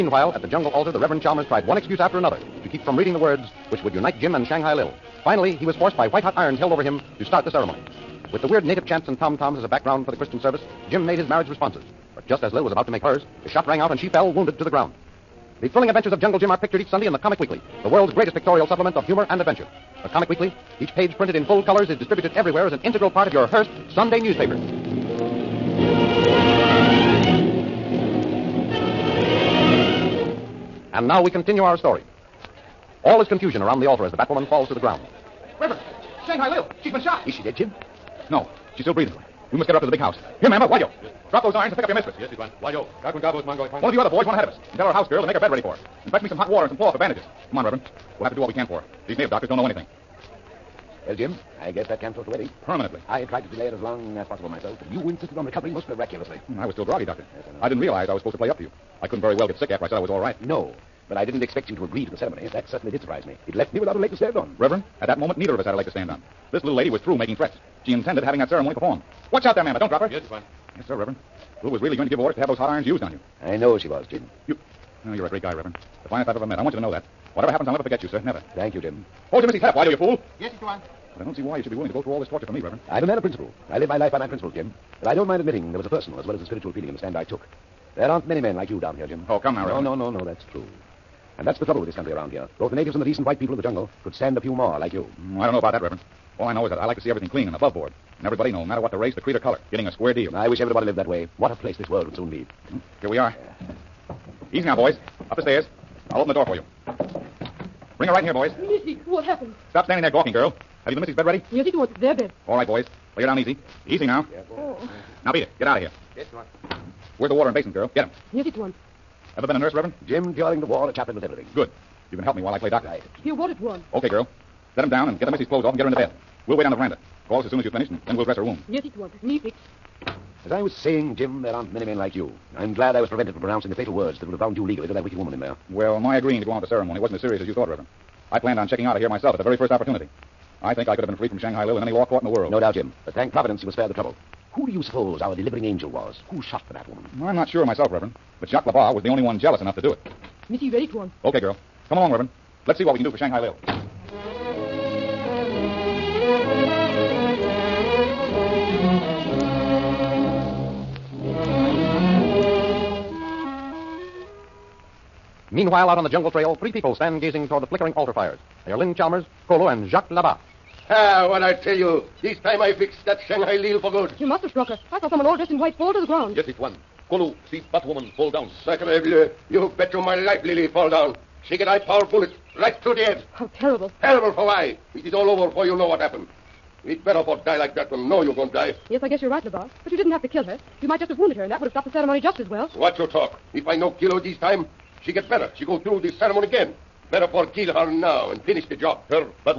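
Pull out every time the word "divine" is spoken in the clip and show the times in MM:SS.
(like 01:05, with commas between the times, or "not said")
not said.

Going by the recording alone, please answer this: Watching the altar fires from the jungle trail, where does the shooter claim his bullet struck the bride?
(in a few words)
Through the head.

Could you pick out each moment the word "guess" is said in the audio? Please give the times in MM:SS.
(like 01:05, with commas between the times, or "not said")
00:51, 03:09.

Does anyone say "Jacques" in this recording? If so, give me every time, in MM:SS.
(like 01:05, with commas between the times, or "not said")
02:28, 02:49.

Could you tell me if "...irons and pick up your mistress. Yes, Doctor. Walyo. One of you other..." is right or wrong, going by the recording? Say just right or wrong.
wrong.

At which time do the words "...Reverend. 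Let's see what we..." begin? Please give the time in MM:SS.
02:32.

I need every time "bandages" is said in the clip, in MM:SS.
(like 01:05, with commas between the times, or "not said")
00:46.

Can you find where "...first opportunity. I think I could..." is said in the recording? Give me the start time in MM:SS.
02:19.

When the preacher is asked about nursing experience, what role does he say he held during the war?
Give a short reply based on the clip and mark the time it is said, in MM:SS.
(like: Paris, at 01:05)
Chaplain, at 02:00.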